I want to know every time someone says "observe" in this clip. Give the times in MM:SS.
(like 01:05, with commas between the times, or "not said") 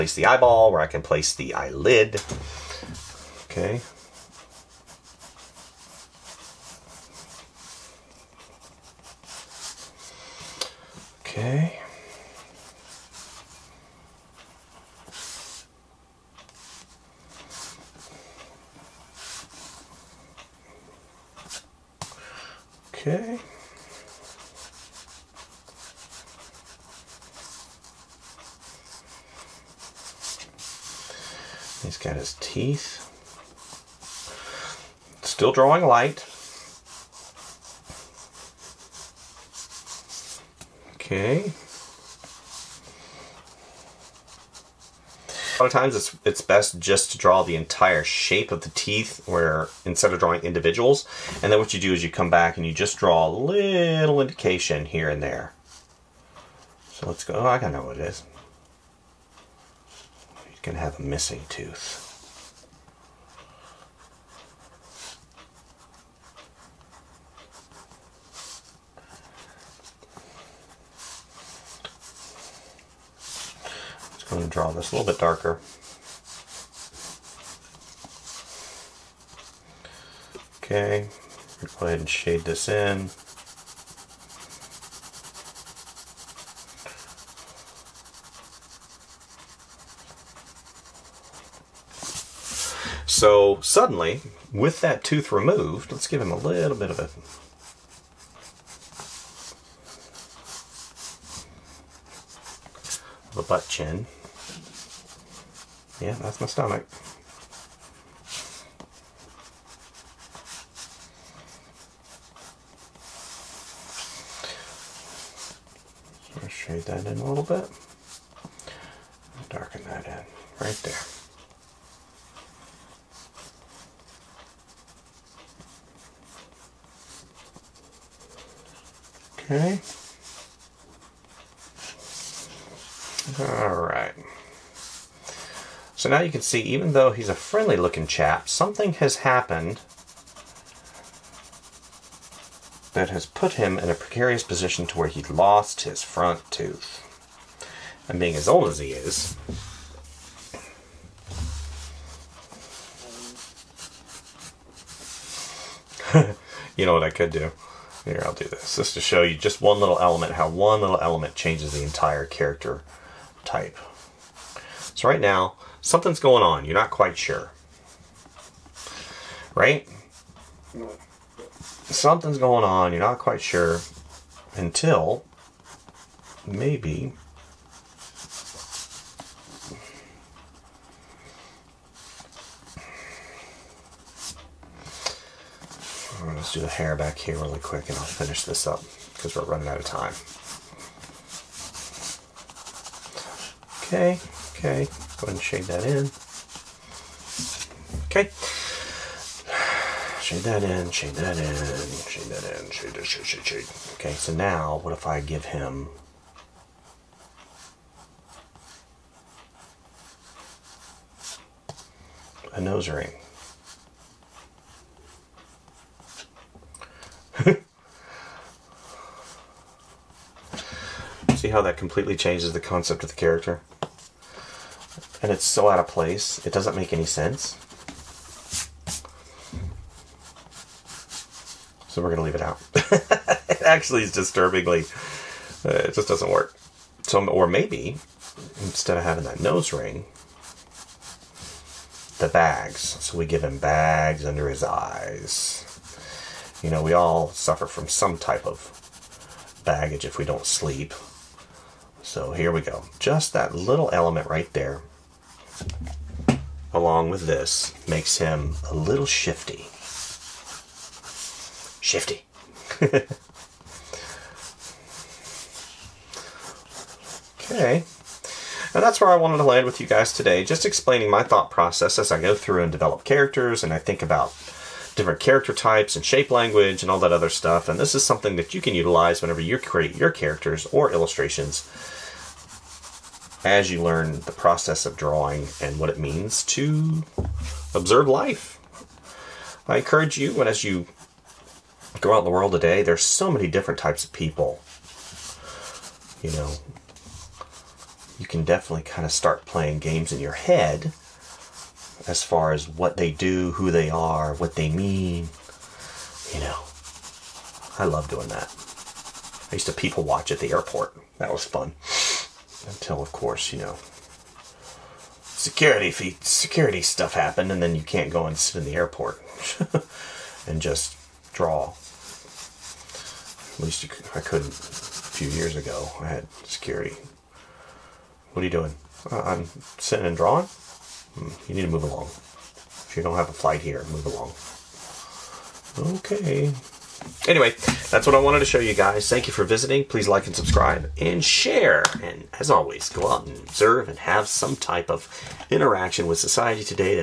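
04:47, 05:43.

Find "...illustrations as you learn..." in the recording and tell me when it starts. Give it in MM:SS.
04:40.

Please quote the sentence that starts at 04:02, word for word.
So we give him bags under his eyes.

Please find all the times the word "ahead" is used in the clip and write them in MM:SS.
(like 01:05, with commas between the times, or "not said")
01:21, 03:15.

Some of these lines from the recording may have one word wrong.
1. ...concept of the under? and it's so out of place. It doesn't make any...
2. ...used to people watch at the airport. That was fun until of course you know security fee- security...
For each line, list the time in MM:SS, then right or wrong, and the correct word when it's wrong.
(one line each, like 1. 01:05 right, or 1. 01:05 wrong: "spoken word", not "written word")
1. 03:42 wrong: "character", not "under"
2. 05:09 right.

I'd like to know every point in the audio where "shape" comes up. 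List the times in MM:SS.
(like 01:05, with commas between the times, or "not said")
00:48, 04:36.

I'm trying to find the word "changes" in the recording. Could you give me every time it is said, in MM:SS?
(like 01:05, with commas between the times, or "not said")
02:41, 03:42.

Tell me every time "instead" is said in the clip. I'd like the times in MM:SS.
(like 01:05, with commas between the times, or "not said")
00:49, 03:58.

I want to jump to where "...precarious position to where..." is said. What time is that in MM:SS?
02:23.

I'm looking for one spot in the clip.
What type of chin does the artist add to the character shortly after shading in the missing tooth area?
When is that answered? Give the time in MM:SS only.
01:43.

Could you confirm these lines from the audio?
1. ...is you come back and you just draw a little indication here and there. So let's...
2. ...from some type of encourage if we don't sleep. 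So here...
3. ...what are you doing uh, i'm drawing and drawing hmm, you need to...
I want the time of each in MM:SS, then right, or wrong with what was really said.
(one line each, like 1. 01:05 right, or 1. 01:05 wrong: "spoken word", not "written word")
1. 00:51 right
2. 04:07 wrong: "baggage", not "encourage"
3. 05:28 wrong: "sitting", not "drawing".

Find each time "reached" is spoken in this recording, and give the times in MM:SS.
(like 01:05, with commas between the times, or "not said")
not said.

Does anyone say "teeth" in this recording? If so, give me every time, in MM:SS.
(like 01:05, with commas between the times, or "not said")
00:32, 00:48.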